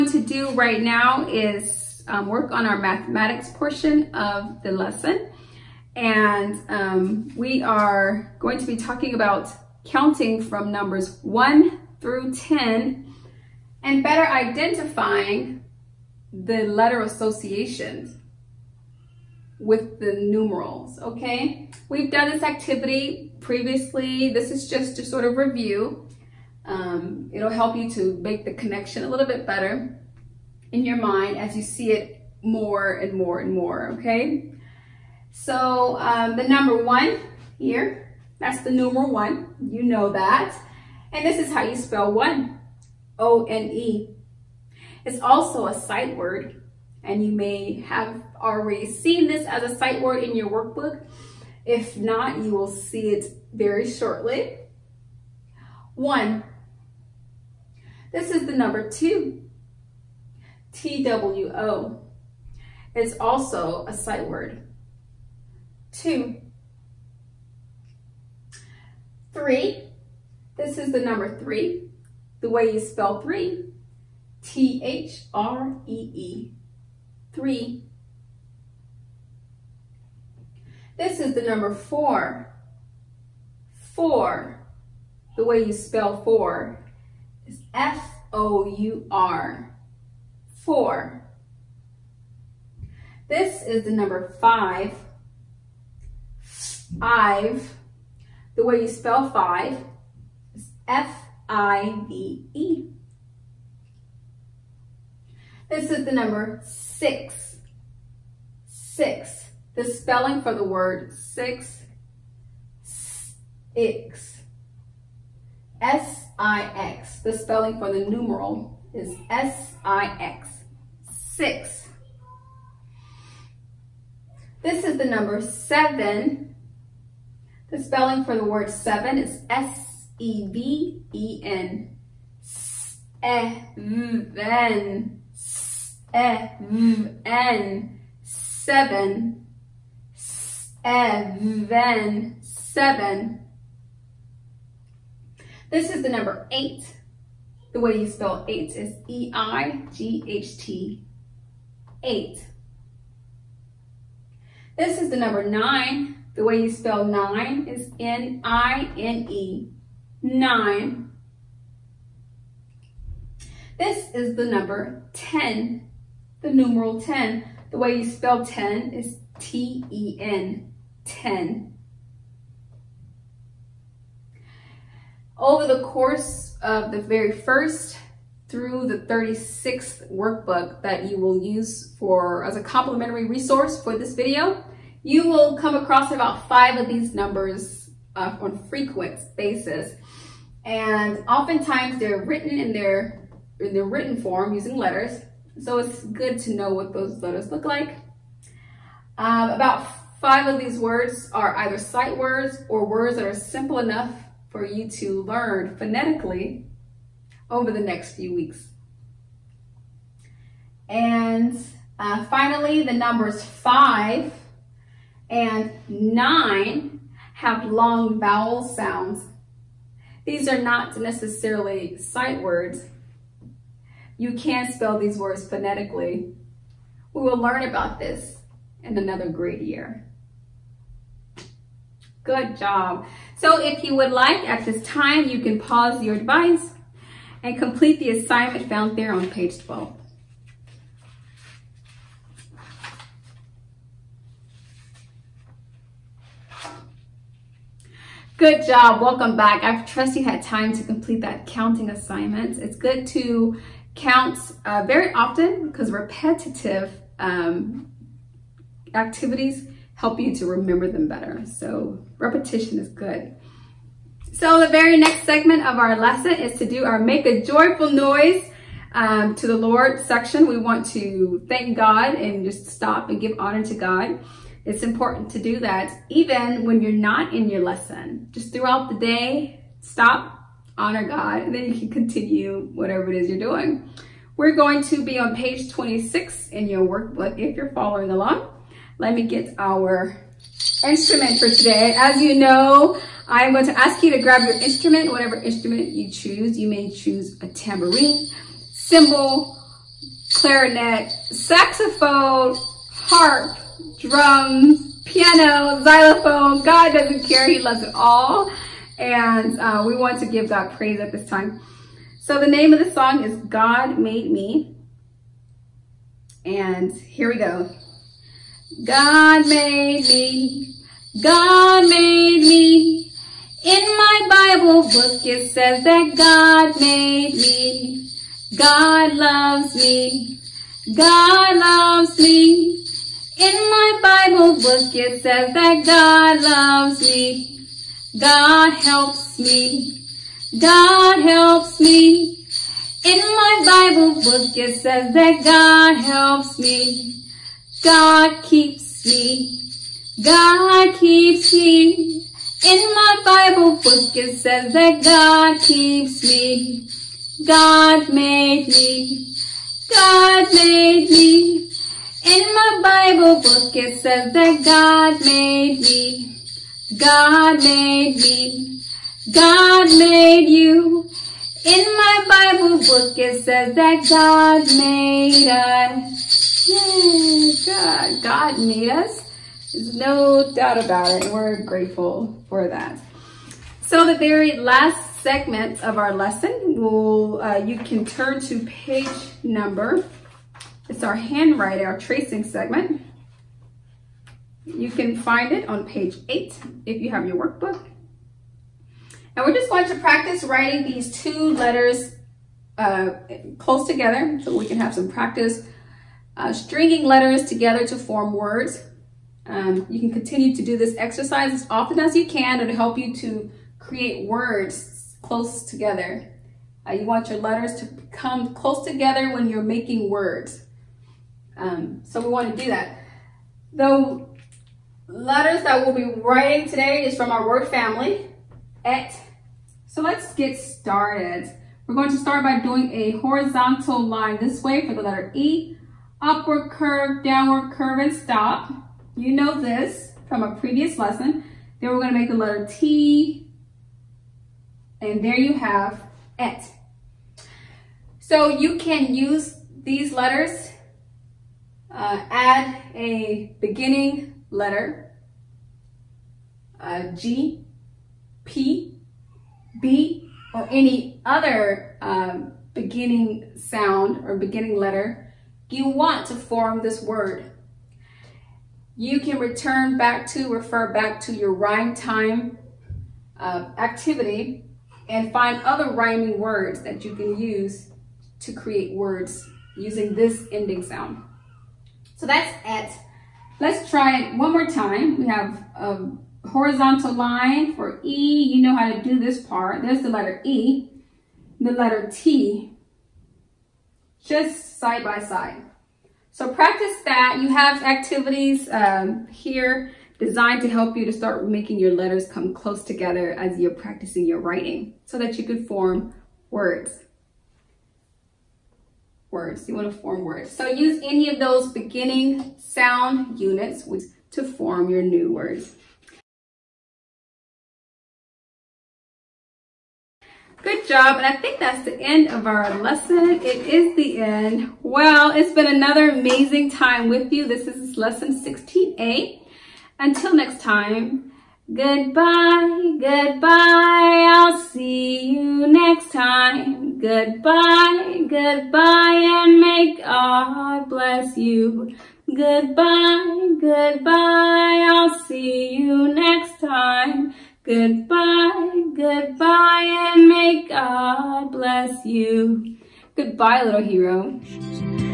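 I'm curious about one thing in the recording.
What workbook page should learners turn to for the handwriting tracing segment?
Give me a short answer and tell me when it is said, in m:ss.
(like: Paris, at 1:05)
page 8, at 6:35.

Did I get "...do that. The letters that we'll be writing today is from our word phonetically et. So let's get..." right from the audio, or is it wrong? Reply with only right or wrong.
wrong.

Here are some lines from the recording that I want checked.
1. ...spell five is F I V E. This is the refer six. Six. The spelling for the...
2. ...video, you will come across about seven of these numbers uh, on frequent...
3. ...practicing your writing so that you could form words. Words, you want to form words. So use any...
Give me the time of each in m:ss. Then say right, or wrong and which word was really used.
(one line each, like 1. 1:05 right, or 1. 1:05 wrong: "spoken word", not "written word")
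1. 1:38 wrong: "number", not "refer"
2. 3:04 wrong: "five", not "seven"
3. 8:23 right.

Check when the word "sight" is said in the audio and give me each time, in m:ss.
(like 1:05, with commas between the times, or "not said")
0:45, 0:49, 1:03, 3:21, 3:41.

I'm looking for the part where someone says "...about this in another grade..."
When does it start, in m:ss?
3:47.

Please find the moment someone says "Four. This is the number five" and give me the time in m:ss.
1:30.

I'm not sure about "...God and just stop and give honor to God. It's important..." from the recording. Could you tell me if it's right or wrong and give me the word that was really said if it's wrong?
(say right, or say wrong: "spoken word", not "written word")
right.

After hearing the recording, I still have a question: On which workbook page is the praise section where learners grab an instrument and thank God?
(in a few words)
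page 26.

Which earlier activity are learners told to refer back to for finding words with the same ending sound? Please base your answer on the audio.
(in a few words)
rhyme time.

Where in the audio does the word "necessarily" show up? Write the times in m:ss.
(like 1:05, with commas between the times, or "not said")
3:40.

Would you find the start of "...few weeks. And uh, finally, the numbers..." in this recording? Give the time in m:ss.
3:28.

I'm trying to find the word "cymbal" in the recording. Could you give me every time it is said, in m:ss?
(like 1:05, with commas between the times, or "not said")
4:58.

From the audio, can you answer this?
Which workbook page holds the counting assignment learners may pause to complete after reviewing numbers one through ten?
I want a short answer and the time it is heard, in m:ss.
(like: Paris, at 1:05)
page 12, at 3:59.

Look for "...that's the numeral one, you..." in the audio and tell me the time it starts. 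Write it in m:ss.
0:38.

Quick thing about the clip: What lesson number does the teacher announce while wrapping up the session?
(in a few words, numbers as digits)
16A.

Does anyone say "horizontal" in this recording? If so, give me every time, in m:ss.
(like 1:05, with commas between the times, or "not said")
7:13, 8:06.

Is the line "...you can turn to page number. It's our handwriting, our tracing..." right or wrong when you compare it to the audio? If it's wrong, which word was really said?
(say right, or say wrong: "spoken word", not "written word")
right.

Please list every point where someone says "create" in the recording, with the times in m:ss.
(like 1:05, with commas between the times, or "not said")
6:53, 7:58.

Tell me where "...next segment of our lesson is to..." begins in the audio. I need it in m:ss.
4:24.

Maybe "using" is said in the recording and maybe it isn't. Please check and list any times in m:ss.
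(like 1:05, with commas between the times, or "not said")
3:14, 7:59.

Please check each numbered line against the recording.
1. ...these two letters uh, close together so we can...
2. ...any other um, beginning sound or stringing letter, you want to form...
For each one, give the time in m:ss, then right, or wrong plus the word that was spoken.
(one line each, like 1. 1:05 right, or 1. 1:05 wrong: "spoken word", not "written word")
1. 6:40 right
2. 7:40 wrong: "beginning", not "stringing".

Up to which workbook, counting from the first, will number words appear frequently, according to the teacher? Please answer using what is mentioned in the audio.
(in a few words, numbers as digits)
36th.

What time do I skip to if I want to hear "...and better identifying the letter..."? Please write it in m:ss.
0:13.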